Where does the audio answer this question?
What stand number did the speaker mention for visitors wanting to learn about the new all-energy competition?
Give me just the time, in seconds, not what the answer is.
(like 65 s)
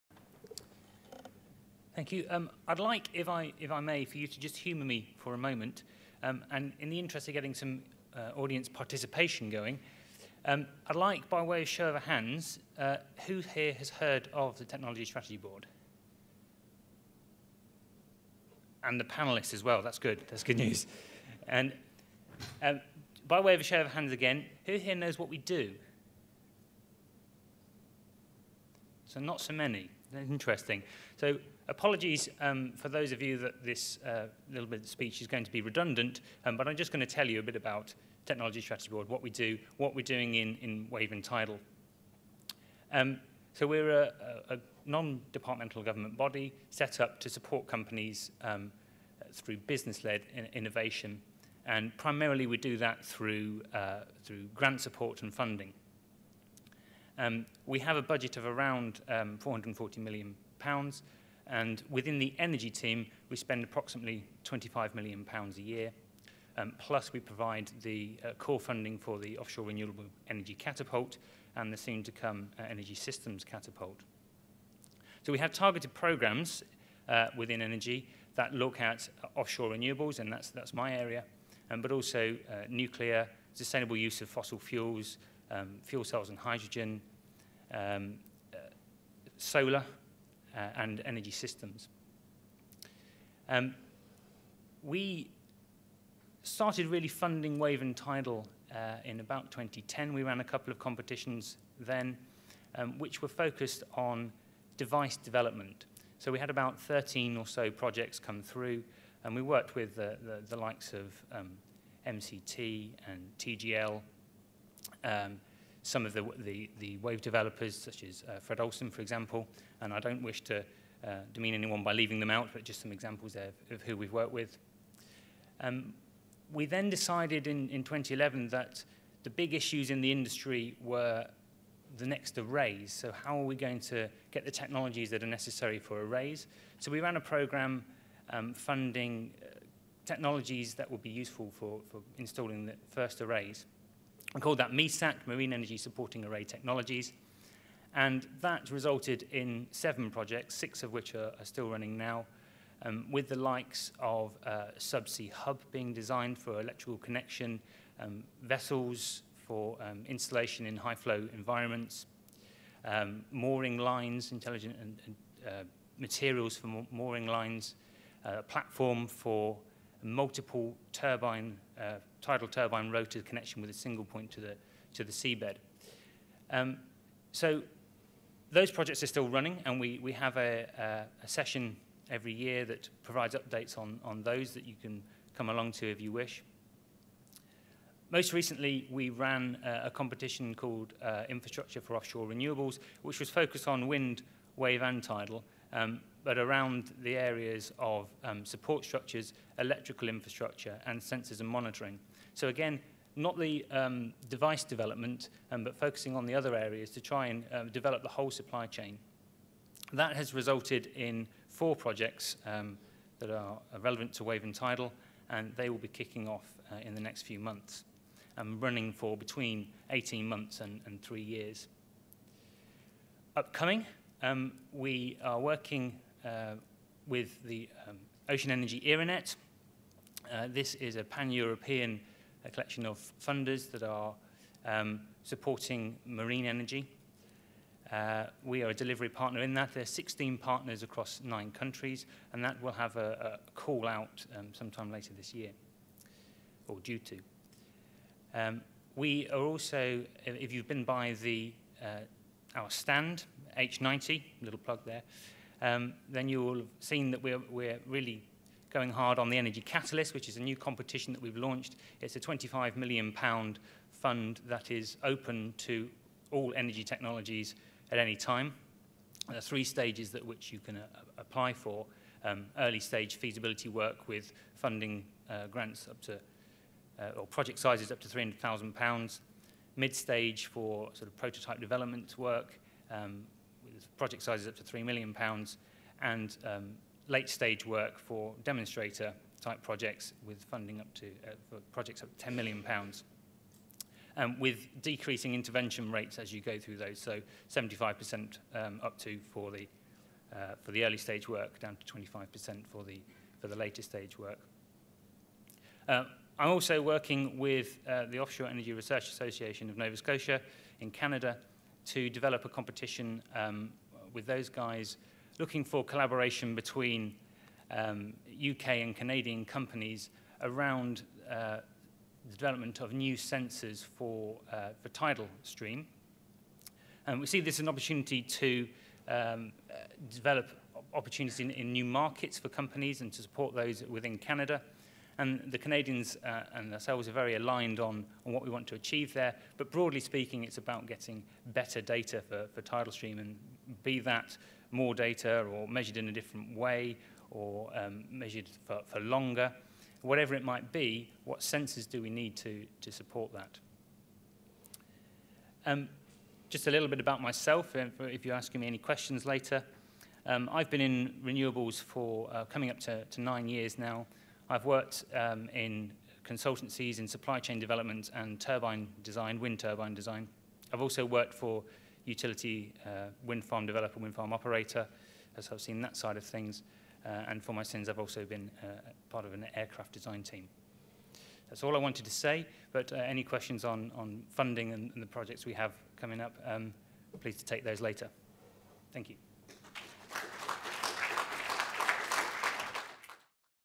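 253 s.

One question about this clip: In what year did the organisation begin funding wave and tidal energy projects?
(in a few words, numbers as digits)
2010.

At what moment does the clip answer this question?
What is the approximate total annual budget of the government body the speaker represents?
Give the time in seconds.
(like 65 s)
59 s.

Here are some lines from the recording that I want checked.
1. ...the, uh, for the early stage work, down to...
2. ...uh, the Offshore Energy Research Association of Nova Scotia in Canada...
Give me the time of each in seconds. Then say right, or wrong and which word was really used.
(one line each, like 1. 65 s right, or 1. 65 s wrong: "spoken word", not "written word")
1. 299 s right
2. 307 s right.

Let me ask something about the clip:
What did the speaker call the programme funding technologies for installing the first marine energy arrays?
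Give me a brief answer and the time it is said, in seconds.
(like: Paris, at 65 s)
MESAT, at 144 s.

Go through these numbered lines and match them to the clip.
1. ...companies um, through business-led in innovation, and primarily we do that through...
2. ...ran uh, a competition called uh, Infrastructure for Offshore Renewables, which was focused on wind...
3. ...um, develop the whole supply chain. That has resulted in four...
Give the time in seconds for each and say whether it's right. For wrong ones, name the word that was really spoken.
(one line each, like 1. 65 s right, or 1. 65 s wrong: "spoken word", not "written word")
1. 47 s right
2. 189 s right
3. 207 s right.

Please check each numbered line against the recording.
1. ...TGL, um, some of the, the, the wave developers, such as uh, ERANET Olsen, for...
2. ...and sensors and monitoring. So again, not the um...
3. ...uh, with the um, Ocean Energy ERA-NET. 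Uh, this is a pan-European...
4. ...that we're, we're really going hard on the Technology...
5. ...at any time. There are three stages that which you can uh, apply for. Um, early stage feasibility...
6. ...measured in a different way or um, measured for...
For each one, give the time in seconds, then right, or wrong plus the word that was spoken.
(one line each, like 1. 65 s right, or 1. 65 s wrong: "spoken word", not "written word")
1. 113 s wrong: "Fred", not "ERANET"
2. 200 s right
3. 226 s right
4. 257 s wrong: "Energy", not "Technology"
5. 267 s right
6. 345 s right.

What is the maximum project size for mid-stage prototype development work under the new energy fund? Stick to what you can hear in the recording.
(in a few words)
£3 million.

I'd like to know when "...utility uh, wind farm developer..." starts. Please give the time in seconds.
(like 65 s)
372 s.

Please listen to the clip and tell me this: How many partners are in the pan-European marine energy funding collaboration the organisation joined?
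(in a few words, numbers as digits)
16.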